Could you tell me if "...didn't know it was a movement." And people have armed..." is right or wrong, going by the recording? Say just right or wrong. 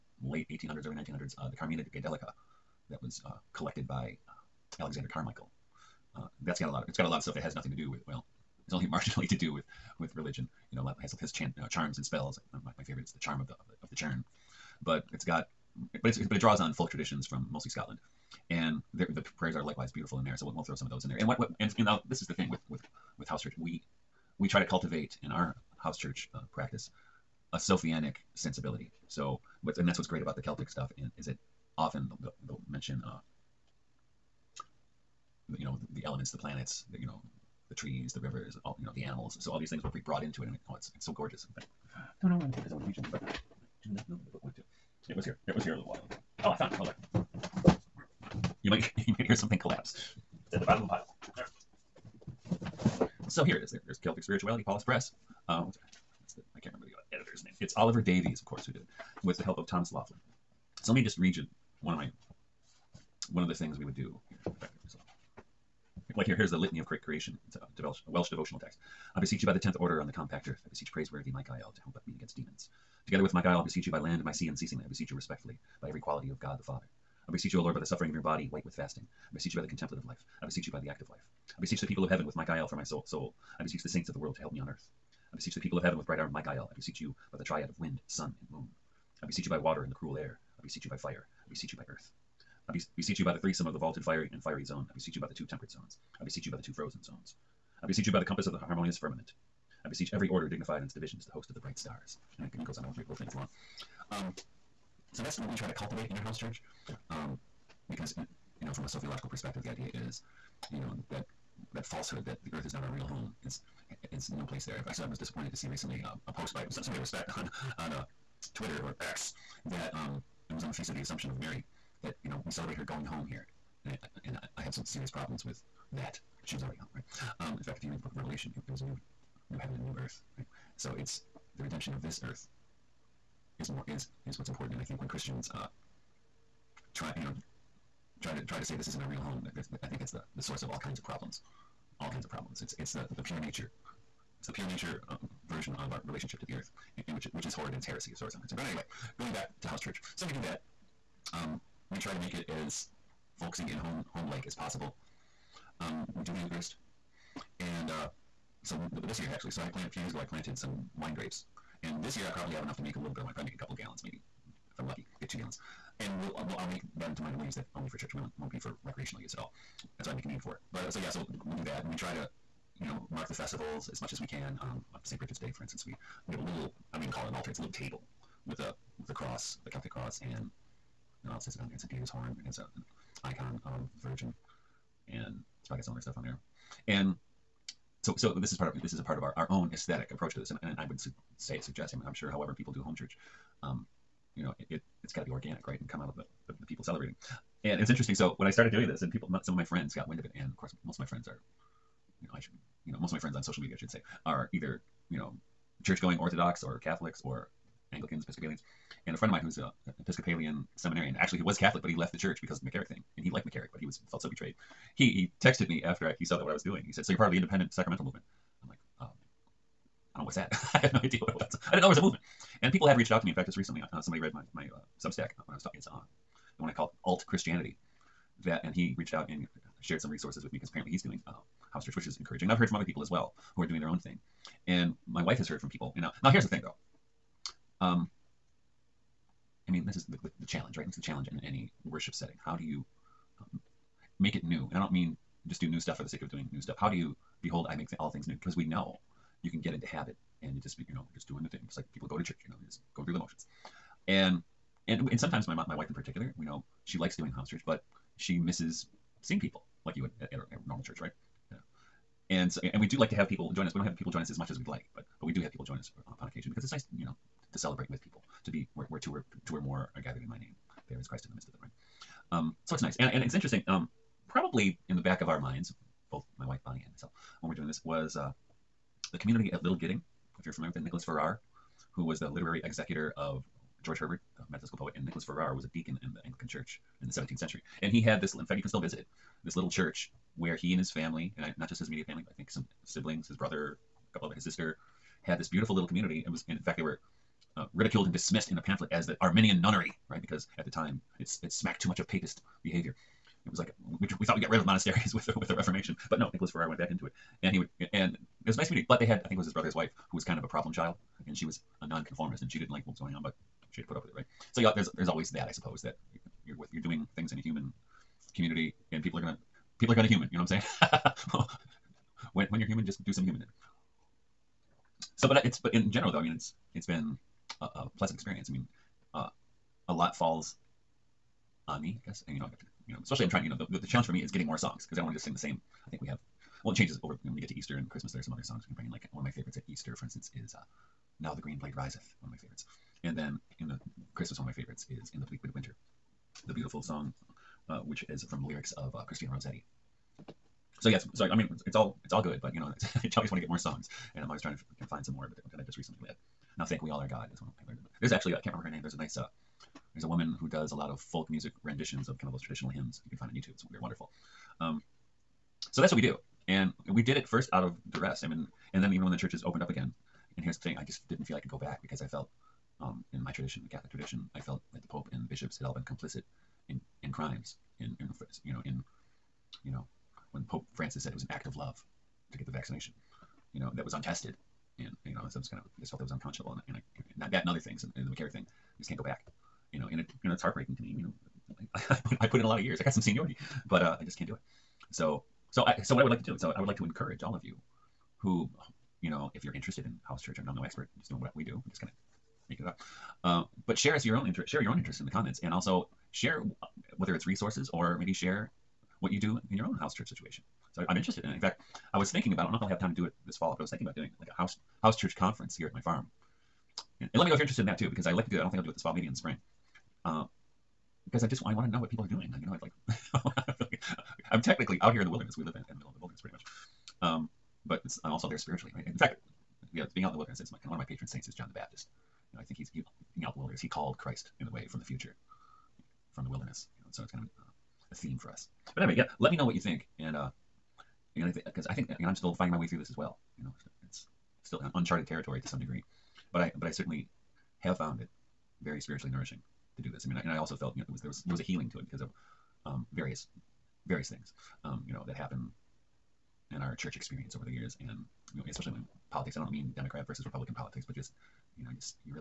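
wrong.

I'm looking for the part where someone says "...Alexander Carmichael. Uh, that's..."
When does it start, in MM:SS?
00:04.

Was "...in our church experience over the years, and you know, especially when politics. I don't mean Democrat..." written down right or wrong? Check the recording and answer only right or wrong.
right.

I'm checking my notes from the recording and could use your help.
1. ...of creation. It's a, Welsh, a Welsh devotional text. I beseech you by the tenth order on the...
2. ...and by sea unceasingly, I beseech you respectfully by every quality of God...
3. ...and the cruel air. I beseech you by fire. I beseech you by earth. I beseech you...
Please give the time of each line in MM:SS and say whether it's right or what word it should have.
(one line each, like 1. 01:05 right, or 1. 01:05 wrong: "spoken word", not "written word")
1. 01:06 right
2. 01:14 right
3. 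01:29 right.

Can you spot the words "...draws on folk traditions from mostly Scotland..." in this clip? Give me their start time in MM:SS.
00:16.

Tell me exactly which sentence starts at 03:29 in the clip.
And a friend of mine who's a, an Episcopalian seminarian.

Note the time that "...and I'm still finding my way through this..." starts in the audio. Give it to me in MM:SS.
07:21.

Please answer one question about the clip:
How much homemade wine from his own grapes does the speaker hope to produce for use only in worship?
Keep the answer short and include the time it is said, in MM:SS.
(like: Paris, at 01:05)
2 gallons, at 02:45.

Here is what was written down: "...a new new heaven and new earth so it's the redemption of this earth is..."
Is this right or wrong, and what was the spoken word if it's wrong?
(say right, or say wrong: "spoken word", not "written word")
right.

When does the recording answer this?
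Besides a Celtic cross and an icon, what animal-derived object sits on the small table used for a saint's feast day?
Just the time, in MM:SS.
03:01.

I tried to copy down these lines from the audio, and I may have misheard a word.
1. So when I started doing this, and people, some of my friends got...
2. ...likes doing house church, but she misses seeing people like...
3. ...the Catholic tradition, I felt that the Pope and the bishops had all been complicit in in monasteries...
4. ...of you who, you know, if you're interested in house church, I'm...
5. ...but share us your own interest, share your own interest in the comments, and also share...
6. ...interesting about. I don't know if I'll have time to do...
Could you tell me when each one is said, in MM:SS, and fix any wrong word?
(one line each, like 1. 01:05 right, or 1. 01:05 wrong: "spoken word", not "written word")
1. 03:18 right
2. 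04:16 right
3. 06:13 wrong: "crimes", not "monasteries"
4. 06:37 right
5. 06:43 right
6. 06:52 wrong: "thinking", not "interesting".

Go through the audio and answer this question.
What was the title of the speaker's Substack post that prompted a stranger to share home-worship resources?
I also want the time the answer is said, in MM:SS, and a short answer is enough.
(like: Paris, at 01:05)
Alt Christianity, at 03:47.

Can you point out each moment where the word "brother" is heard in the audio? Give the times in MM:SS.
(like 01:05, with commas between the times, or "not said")
04:53, 05:09.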